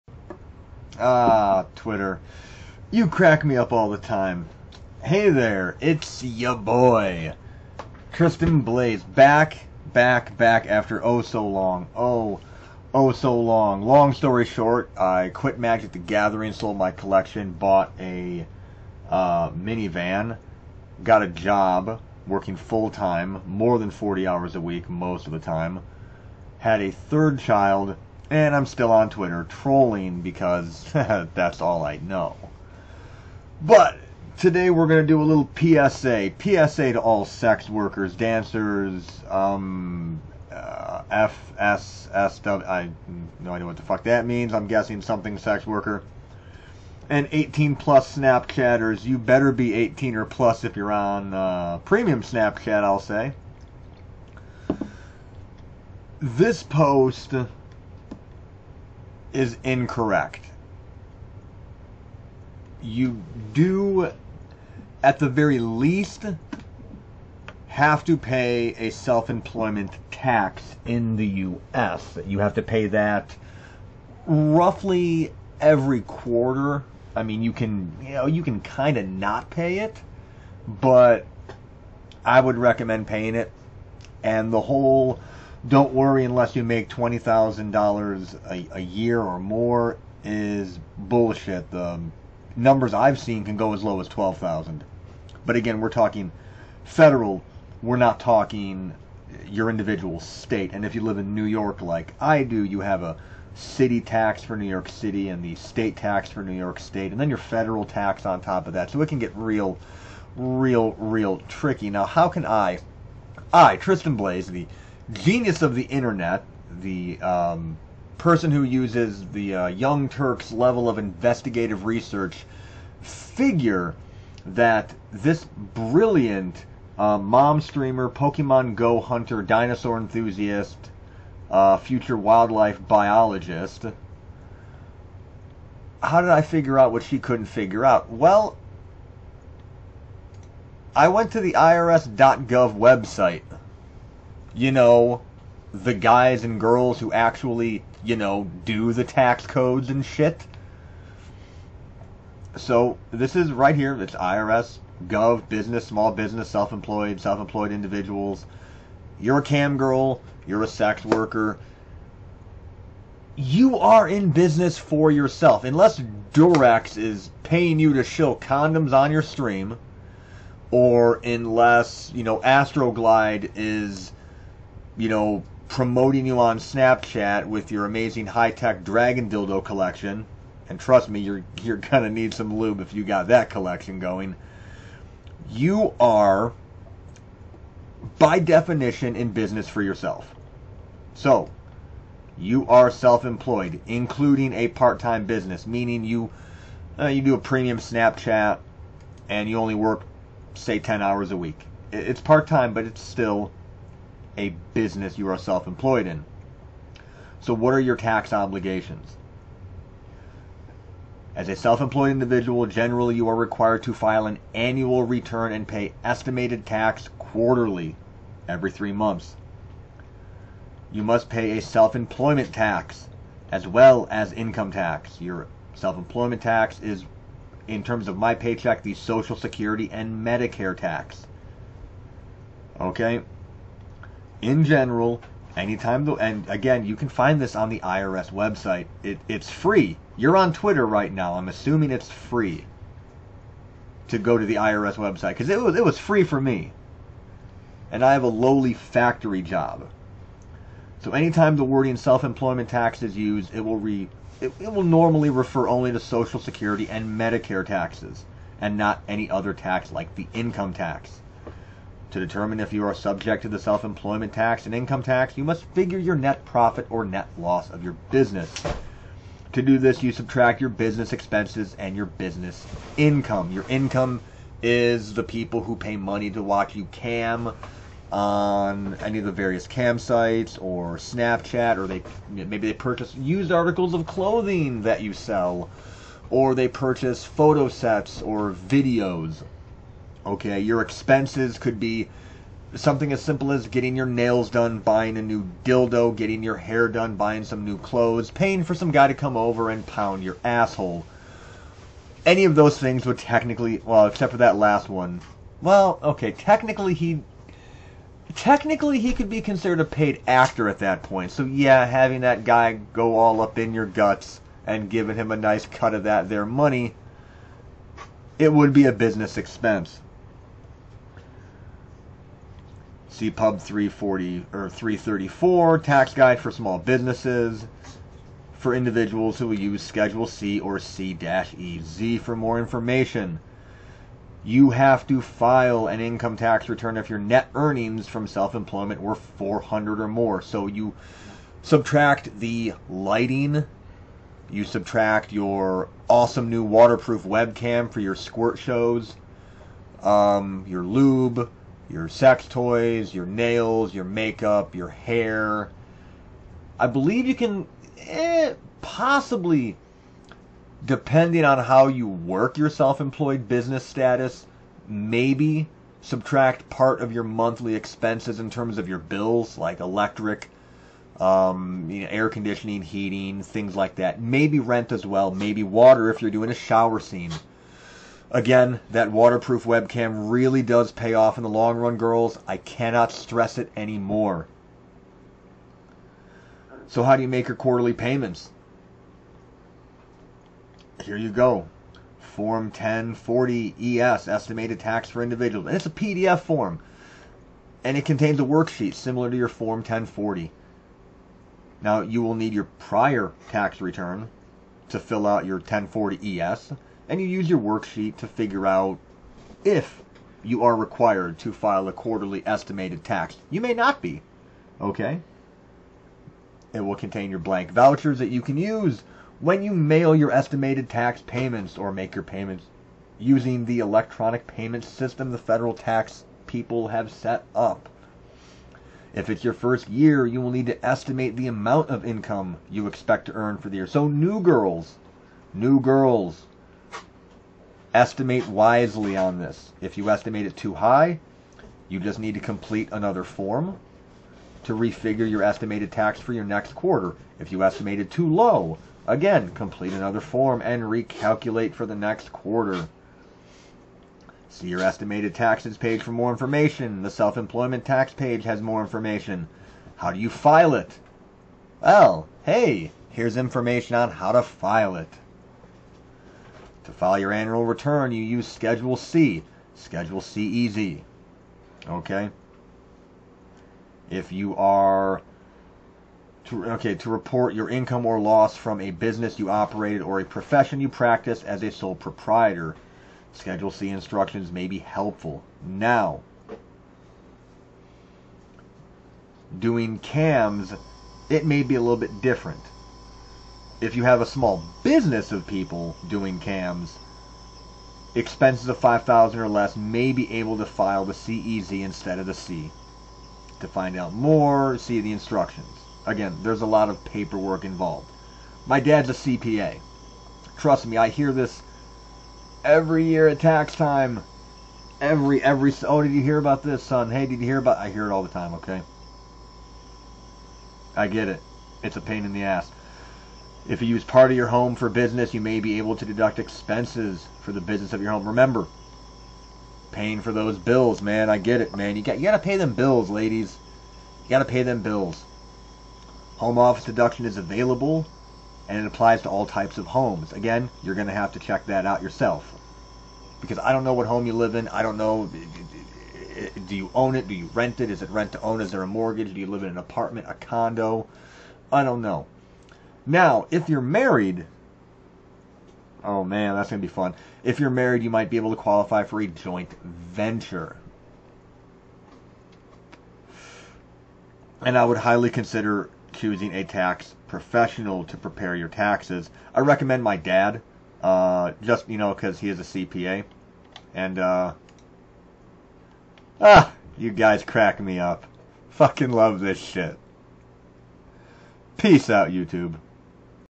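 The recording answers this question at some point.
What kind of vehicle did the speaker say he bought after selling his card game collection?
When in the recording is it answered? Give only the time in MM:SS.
00:19.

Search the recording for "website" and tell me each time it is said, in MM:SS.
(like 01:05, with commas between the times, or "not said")
02:22, 03:58, 04:04.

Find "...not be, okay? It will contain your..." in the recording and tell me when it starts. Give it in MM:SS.
06:53.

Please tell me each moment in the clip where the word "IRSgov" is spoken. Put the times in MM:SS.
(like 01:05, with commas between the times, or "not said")
02:21.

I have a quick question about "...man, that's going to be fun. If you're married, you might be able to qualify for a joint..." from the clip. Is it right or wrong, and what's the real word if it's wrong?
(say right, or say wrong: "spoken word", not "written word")
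right.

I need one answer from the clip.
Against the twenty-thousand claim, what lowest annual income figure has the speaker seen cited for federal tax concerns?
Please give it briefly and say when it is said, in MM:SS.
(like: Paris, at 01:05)
12,000, at 01:34.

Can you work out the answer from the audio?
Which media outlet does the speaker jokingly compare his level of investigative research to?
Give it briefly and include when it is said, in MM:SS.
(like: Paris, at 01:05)
Young Turks, at 01:59.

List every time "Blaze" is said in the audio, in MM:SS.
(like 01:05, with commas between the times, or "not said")
00:08, 01:54.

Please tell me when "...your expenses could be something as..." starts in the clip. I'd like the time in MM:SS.
04:50.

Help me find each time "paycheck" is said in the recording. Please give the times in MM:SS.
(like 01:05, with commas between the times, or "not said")
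03:48.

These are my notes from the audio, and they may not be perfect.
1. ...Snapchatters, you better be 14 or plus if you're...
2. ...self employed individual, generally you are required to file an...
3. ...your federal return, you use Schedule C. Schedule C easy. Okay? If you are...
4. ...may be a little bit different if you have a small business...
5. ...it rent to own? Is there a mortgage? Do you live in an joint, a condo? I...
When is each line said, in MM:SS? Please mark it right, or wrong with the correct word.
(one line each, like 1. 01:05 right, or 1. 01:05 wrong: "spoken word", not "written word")
1. 00:48 wrong: "18", not "14"
2. 03:31 right
3. 07:47 wrong: "annual", not "federal"
4. 08:11 right
5. 09:08 wrong: "apartment", not "joint".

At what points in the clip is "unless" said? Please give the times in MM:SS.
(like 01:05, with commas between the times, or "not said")
01:26, 02:45, 02:51.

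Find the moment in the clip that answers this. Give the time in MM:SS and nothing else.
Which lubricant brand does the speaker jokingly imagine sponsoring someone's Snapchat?
02:52.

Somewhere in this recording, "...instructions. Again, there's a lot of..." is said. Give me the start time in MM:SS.
08:25.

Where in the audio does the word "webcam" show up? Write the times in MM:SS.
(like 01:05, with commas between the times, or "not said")
05:47, 06:19.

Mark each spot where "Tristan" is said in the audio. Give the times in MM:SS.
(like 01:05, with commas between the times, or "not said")
00:08, 01:53.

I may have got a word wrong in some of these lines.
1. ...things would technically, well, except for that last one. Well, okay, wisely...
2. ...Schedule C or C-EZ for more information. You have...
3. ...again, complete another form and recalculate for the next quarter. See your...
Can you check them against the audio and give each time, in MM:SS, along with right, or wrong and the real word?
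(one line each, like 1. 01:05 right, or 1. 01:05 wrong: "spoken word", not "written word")
1. 05:02 wrong: "technically", not "wisely"
2. 05:29 right
3. 07:29 right.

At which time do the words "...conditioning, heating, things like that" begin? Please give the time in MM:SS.
06:12.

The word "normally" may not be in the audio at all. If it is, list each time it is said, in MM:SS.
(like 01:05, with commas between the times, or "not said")
04:14.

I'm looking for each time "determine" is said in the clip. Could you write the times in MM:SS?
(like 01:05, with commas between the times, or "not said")
04:22.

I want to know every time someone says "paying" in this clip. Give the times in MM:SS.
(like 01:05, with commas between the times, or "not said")
01:23, 02:47, 04:58, 08:49.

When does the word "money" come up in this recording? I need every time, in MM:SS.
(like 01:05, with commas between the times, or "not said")
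04:35, 05:16.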